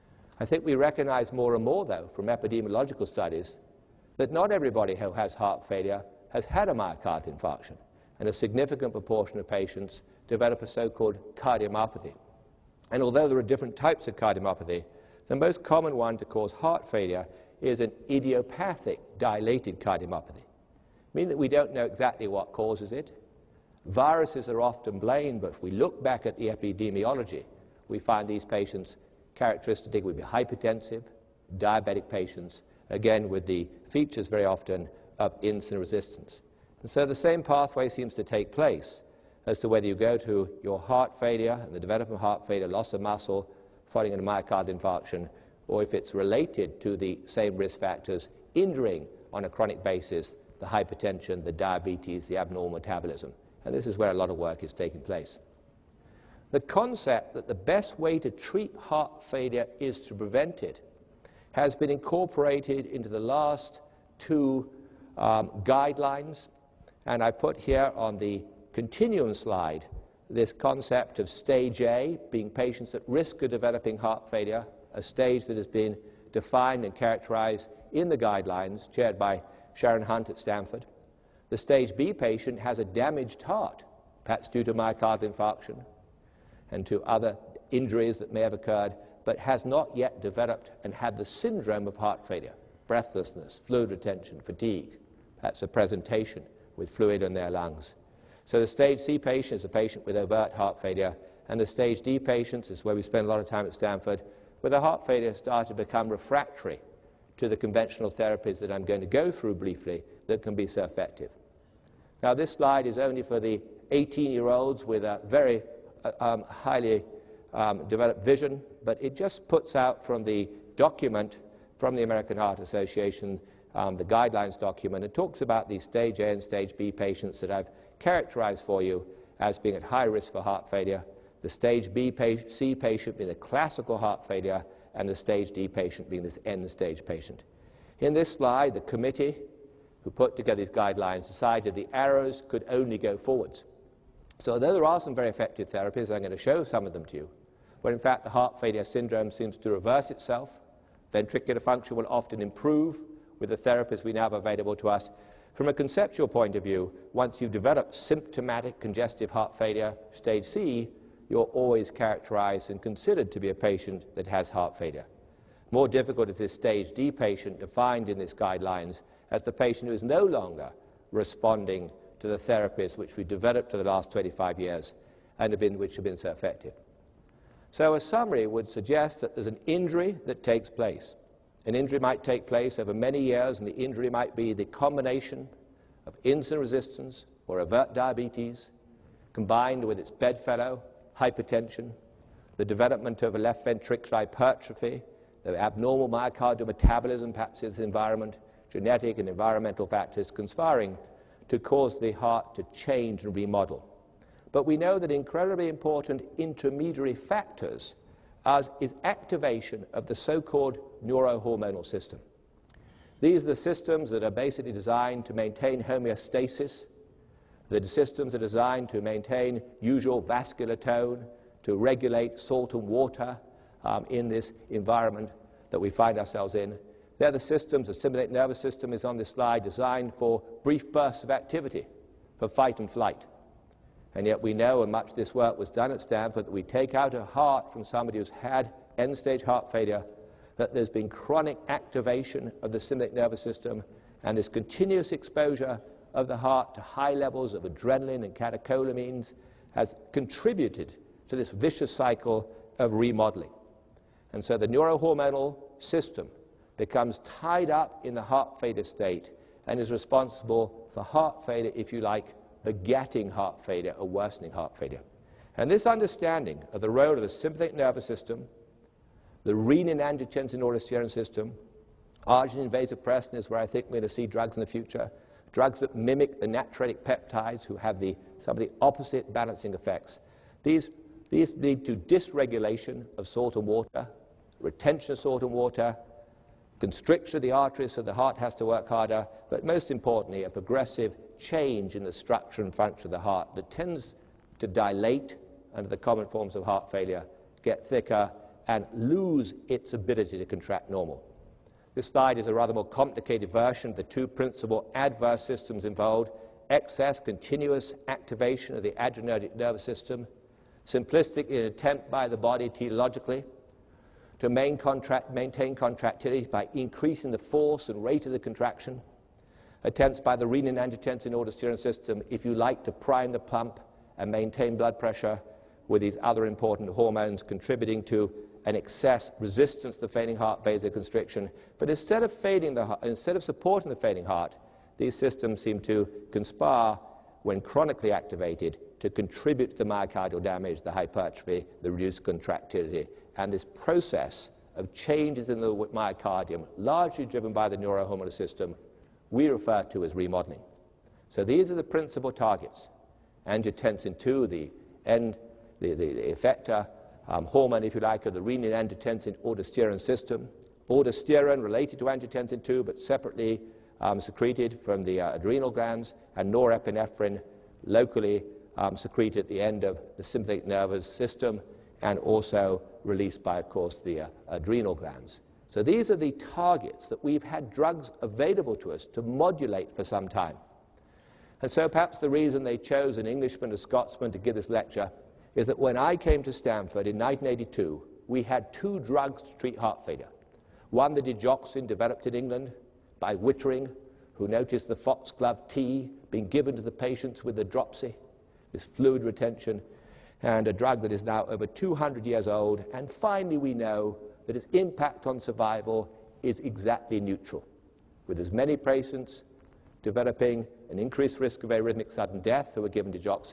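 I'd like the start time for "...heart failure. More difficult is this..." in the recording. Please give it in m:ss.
2:44.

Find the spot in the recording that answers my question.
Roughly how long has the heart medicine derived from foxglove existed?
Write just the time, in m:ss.
6:41.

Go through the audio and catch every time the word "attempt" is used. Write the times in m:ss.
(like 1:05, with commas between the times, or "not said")
5:11, 5:19.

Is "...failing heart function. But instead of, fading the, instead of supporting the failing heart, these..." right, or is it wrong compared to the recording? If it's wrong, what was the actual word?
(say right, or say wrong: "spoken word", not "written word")
wrong: "vasoconstriction", not "function".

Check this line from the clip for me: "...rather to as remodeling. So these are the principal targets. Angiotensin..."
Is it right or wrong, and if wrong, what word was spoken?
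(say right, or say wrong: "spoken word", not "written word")
wrong: "refer", not "rather".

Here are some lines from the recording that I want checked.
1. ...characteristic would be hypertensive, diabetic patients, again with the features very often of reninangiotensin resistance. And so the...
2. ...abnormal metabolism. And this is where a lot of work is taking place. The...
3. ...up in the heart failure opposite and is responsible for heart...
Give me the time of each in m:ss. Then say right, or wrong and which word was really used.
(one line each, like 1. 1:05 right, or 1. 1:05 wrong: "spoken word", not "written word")
1. 0:29 wrong: "insulin", not "reninangiotensin"
2. 0:52 right
3. 4:17 wrong: "state", not "opposite".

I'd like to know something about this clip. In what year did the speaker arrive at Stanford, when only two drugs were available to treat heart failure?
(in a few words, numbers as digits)
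1982.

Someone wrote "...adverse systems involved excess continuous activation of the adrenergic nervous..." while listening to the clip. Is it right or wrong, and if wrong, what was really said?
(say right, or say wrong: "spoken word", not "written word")
right.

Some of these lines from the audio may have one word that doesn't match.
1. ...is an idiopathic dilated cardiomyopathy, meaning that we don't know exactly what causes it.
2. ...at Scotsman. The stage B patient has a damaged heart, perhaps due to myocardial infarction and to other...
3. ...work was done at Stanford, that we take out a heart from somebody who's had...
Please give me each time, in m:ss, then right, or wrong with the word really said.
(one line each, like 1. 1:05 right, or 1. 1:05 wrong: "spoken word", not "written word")
1. 0:17 right
2. 1:20 wrong: "Stanford", not "Scotsman"
3. 3:55 right.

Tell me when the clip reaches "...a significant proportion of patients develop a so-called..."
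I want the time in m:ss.
0:08.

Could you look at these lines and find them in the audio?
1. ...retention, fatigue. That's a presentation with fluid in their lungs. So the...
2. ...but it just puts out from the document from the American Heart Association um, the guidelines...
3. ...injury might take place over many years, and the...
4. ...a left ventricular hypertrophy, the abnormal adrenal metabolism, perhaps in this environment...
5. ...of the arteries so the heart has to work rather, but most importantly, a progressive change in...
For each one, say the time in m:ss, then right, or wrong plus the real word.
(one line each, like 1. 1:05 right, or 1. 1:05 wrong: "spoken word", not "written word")
1. 1:33 right
2. 1:58 right
3. 3:01 right
4. 3:13 wrong: "myocardial", not "adrenal"
5. 4:47 wrong: "harder", not "rather".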